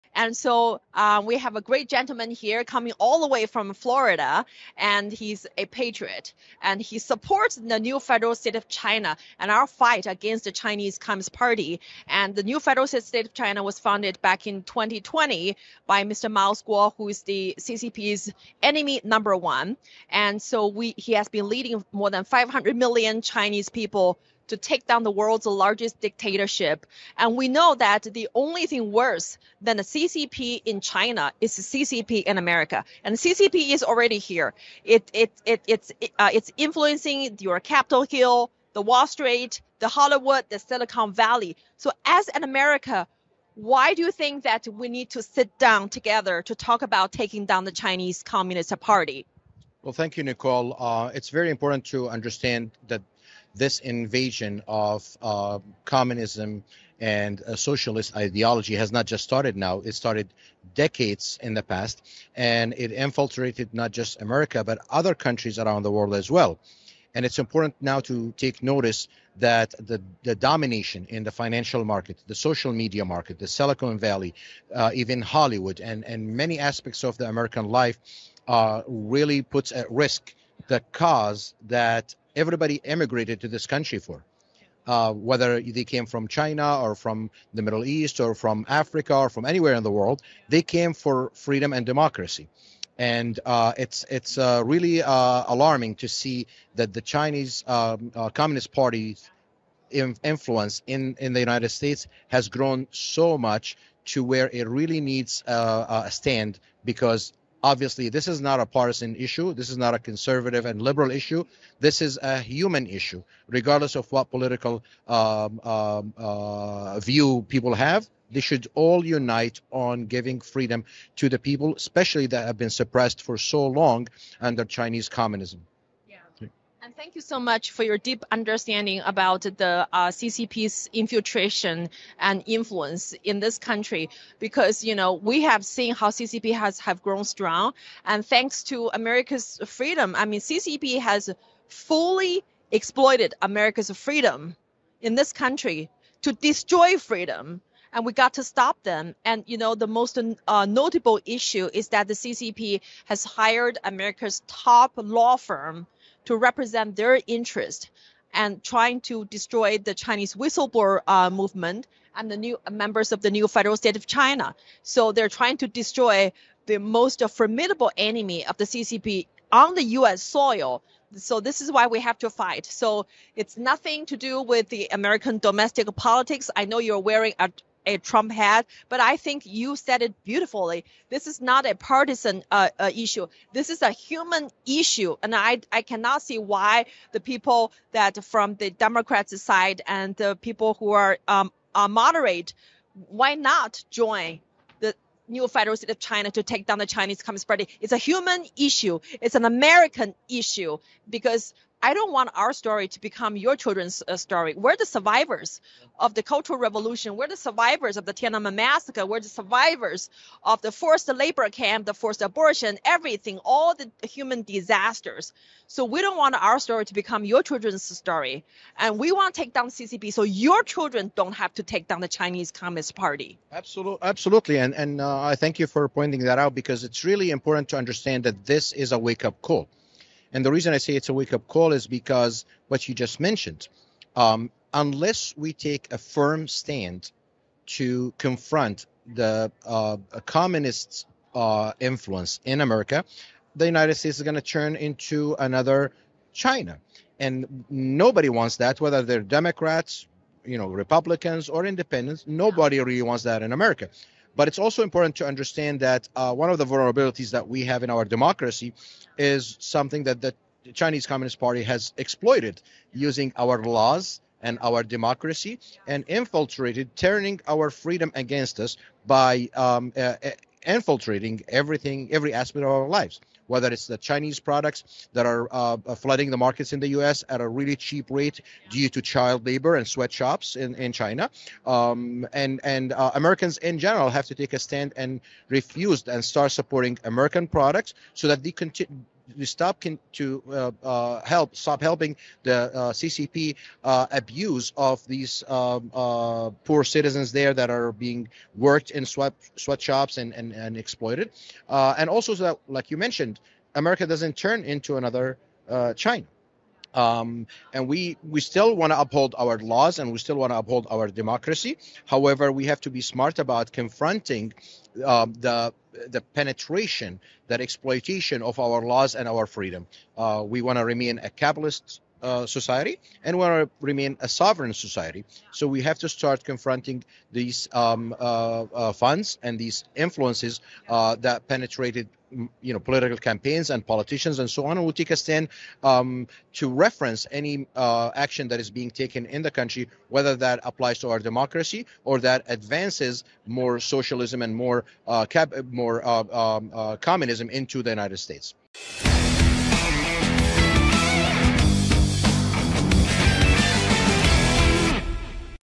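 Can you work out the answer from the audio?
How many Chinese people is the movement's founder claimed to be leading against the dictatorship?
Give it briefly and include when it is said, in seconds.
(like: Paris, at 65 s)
500 million, at 22 s.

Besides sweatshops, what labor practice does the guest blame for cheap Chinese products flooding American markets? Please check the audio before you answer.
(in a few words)
Child labor.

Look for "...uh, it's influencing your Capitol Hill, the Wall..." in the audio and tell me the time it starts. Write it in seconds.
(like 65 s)
36 s.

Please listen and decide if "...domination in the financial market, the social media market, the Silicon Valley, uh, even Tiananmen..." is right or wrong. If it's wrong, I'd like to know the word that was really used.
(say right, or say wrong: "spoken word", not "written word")
wrong: "Hollywood", not "Tiananmen".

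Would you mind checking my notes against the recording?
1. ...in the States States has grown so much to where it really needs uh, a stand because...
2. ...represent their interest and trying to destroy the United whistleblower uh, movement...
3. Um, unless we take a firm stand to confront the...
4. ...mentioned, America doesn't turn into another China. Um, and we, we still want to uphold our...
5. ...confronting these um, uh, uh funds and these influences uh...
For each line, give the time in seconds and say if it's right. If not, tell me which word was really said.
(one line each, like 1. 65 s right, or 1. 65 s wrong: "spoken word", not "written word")
1. 101 s wrong: "United", not "States"
2. 156 s wrong: "Chinese", not "United"
3. 234 s right
4. 302 s right
5. 326 s right.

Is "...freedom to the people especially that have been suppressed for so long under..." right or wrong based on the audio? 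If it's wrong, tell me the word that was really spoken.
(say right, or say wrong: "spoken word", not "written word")
right.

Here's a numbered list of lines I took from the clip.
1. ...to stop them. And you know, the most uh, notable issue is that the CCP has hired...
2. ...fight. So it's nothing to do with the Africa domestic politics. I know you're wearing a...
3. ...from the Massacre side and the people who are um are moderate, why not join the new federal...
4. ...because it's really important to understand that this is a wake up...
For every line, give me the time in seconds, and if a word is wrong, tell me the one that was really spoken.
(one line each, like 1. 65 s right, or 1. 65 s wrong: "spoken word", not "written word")
1. 148 s right
2. 172 s wrong: "American", not "Africa"
3. 188 s wrong: "Democrats", not "Massacre"
4. 226 s right.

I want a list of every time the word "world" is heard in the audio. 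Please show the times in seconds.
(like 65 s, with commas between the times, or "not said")
25 s, 65 s, 89 s.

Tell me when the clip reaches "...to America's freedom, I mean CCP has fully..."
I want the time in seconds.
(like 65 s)
138 s.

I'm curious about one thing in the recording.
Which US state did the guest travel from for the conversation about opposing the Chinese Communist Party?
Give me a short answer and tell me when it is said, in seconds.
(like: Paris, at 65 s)
Florida, at 3 s.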